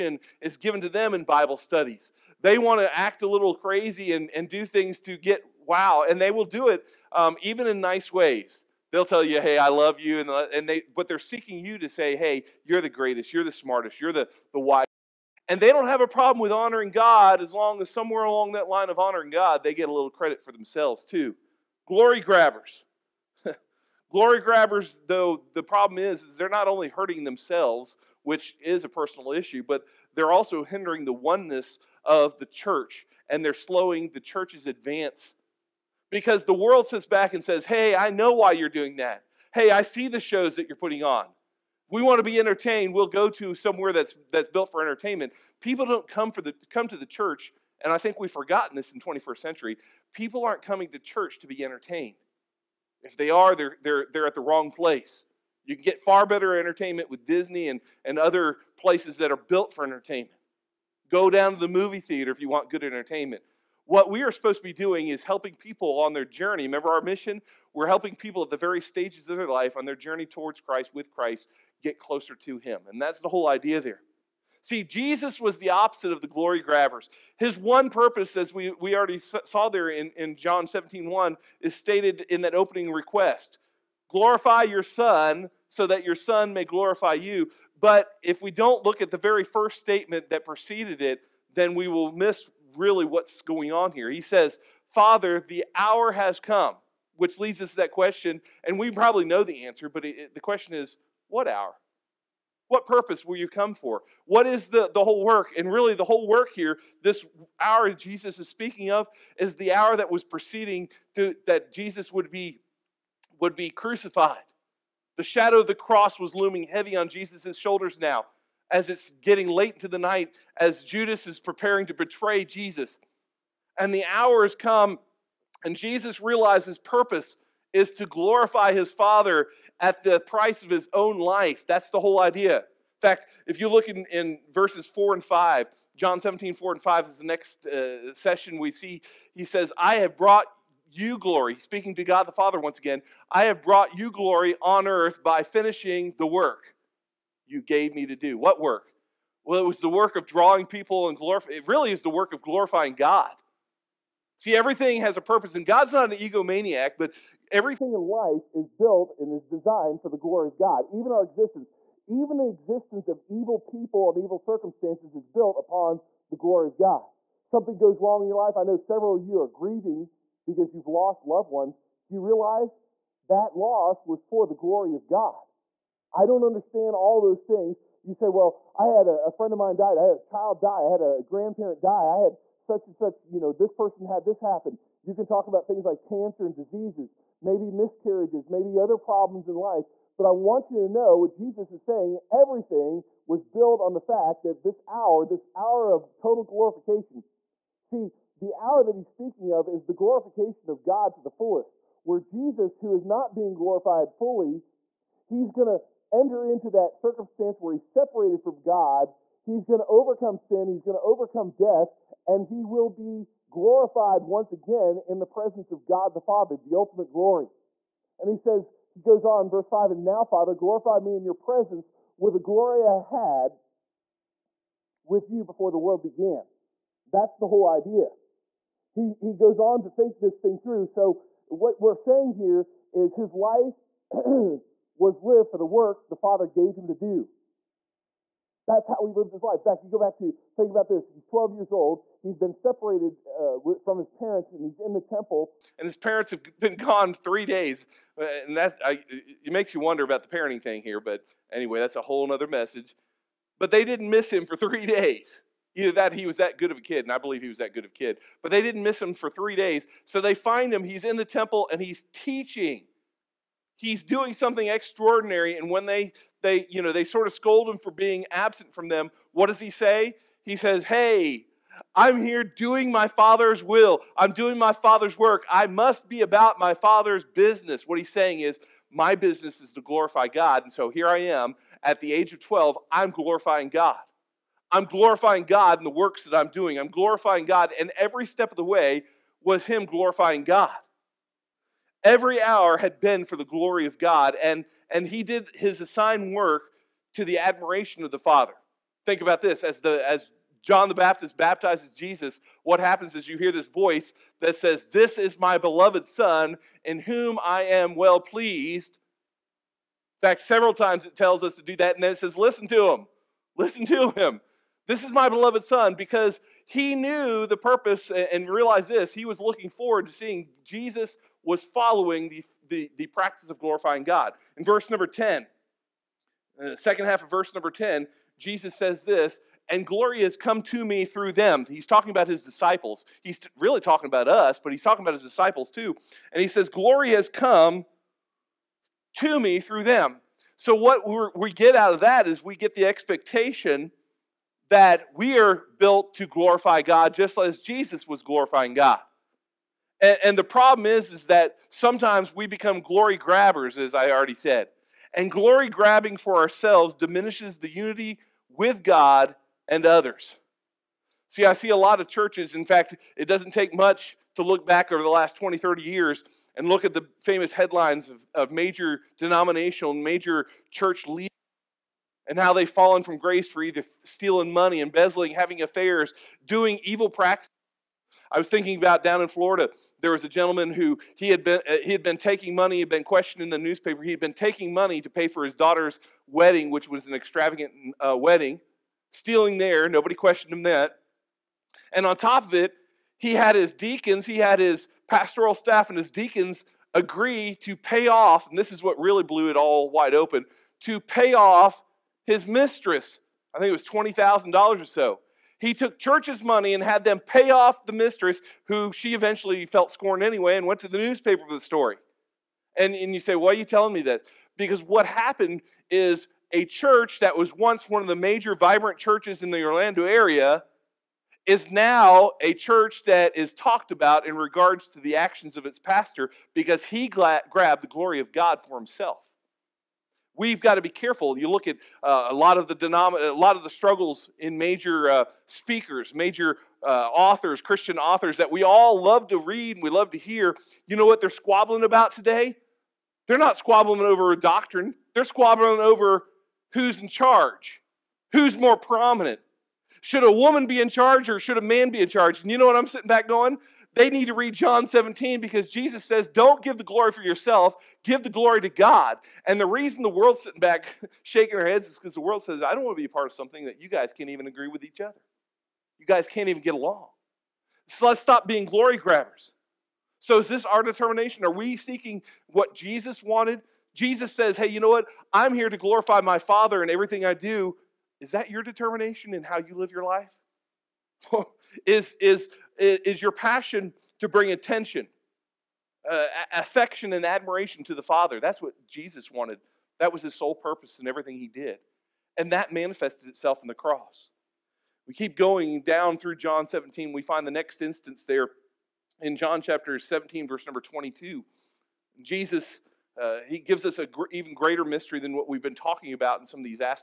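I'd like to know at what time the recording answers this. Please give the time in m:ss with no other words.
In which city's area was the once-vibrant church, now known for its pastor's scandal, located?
6:59.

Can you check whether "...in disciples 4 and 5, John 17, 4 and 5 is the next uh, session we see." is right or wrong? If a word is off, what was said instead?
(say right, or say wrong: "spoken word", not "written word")
wrong: "verses", not "disciples".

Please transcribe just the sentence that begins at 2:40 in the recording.
Even our existence, even the existence of evil people and evil circumstances is built upon the glory of God.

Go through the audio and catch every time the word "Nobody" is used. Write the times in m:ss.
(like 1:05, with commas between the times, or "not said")
6:29.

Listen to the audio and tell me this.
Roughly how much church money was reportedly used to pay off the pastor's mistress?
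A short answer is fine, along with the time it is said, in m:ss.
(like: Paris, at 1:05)
$20,000, at 6:43.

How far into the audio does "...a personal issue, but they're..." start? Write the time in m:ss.
0:28.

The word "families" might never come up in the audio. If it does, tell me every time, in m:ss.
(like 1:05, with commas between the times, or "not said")
not said.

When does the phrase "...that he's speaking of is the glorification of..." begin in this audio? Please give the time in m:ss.
3:18.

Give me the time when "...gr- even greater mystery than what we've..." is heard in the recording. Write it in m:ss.
8:24.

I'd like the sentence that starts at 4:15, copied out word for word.
Either that, he was that good of a kid, and I believe he was that good of a kid.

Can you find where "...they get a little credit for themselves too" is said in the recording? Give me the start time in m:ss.
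0:19.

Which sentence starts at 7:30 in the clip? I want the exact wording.
Should a woman be in charge or should a man be in charge?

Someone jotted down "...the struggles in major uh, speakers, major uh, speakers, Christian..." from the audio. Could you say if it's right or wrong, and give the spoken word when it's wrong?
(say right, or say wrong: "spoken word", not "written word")
wrong: "authors", not "speakers".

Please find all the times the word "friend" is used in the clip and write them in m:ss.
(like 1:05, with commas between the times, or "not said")
2:59.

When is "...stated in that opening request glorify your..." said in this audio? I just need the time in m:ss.
1:21.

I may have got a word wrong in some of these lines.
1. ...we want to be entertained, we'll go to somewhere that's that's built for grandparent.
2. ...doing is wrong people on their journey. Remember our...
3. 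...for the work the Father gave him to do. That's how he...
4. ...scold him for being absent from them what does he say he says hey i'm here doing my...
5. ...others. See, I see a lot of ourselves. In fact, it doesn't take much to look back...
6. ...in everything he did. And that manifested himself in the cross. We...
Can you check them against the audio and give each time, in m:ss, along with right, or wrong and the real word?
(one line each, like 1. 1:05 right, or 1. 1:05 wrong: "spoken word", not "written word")
1. 0:41 wrong: "entertainment", not "grandparent"
2. 1:04 wrong: "helping", not "wrong"
3. 3:55 right
4. 4:27 right
5. 5:59 wrong: "churches", not "ourselves"
6. 8:10 wrong: "itself", not "himself".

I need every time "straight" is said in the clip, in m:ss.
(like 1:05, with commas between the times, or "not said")
not said.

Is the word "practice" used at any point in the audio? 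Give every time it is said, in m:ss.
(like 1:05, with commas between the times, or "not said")
5:23, 6:17.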